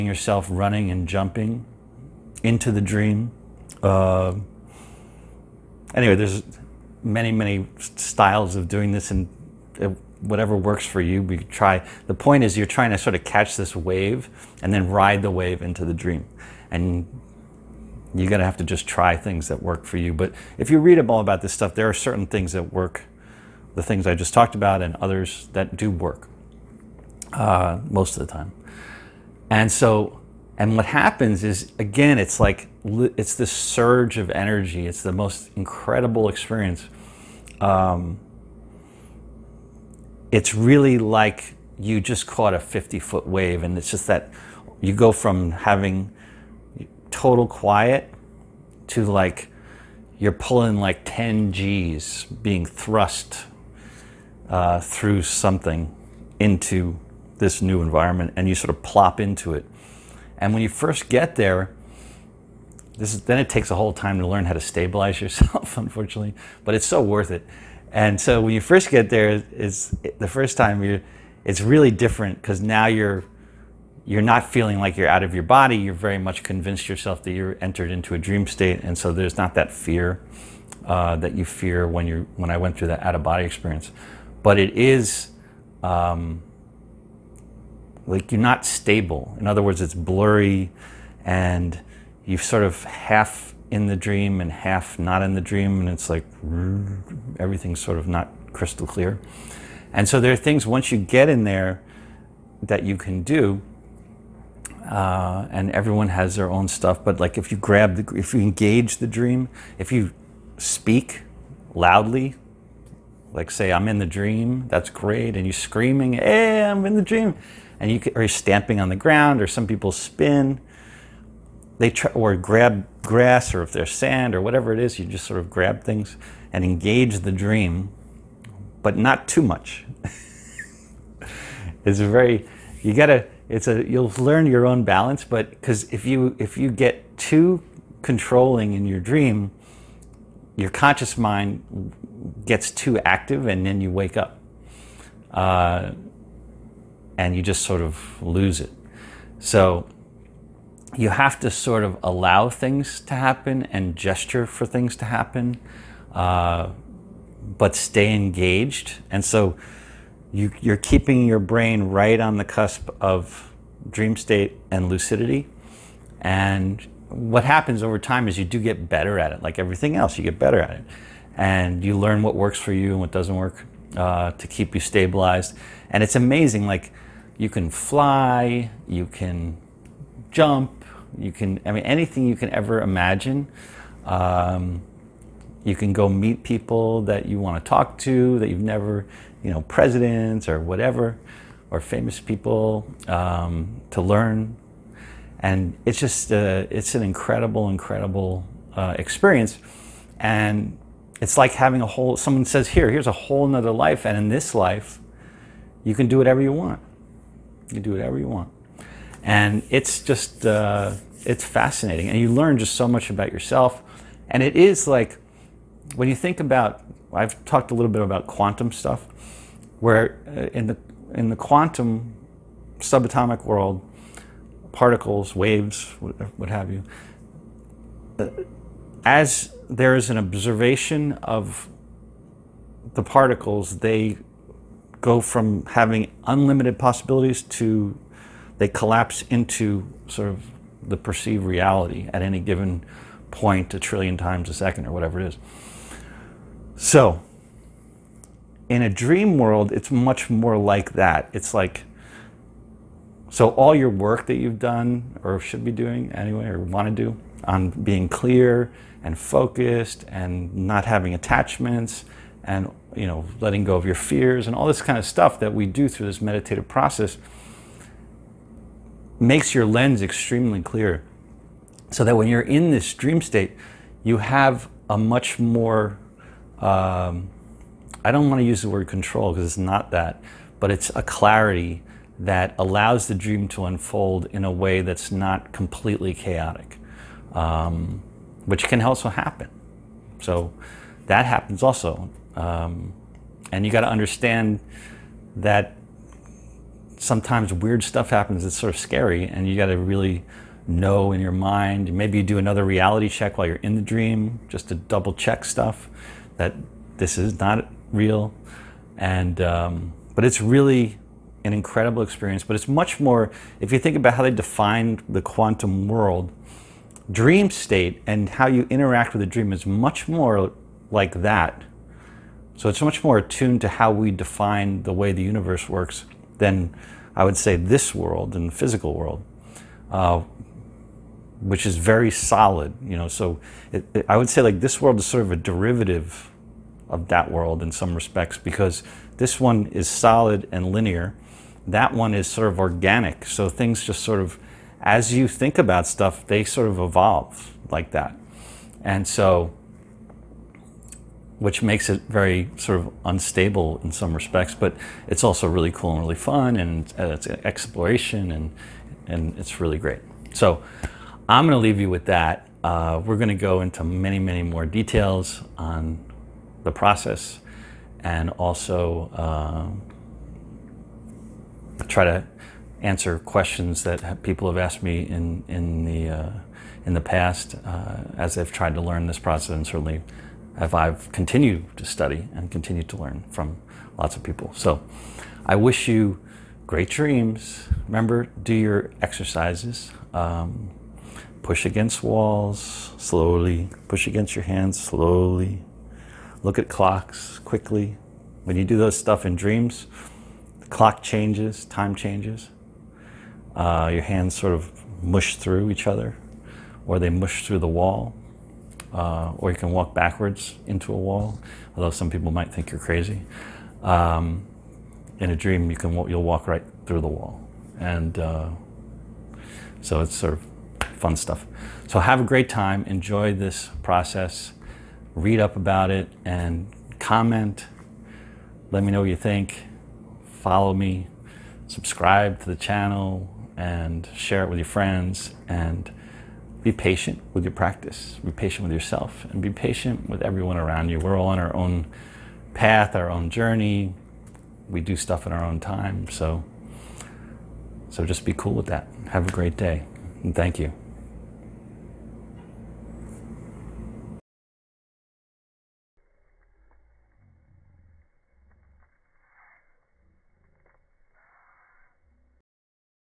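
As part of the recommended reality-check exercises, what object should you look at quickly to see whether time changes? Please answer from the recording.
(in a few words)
Clocks.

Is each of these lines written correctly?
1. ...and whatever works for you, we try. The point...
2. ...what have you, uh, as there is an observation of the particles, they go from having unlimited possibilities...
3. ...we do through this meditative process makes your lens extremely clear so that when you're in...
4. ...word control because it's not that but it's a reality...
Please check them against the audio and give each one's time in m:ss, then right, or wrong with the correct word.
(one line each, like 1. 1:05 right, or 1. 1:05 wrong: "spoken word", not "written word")
1. 0:09 right
2. 3:46 right
3. 4:25 right
4. 4:38 wrong: "clarity", not "reality".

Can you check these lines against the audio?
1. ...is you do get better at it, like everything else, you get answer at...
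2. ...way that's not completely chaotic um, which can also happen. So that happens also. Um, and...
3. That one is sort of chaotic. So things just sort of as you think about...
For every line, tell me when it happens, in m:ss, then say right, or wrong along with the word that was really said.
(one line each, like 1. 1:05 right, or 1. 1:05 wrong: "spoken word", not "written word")
1. 2:48 wrong: "better", not "answer"
2. 4:44 right
3. 5:41 wrong: "organic", not "chaotic".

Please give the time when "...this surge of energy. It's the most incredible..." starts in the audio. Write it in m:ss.
0:33.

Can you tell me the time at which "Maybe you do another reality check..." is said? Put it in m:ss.
5:01.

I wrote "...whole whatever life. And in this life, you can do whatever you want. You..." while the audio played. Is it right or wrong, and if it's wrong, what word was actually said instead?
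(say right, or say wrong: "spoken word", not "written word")
wrong: "nother", not "whatever".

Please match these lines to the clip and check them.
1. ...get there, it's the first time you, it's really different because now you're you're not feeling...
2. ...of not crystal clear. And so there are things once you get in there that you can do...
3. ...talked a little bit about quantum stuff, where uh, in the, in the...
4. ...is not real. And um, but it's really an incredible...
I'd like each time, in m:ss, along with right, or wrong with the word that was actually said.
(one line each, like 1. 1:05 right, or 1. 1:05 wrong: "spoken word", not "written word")
1. 1:08 right
2. 1:37 right
3. 3:37 right
4. 5:07 right.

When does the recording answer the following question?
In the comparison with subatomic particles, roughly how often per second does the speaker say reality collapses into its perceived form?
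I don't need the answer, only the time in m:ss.
4:03.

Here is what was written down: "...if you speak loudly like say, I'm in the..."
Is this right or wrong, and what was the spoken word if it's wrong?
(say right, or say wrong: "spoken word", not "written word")
right.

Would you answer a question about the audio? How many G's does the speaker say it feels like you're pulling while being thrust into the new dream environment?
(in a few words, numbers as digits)
10.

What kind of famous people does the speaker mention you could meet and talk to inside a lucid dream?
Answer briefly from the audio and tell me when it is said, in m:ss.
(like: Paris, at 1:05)
Presidents, at 3:09.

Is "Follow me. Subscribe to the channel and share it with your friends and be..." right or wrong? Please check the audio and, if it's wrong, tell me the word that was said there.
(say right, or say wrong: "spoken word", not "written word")
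right.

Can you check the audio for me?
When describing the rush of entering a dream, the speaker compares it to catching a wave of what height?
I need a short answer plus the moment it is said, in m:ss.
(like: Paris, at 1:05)
50 feet, at 0:42.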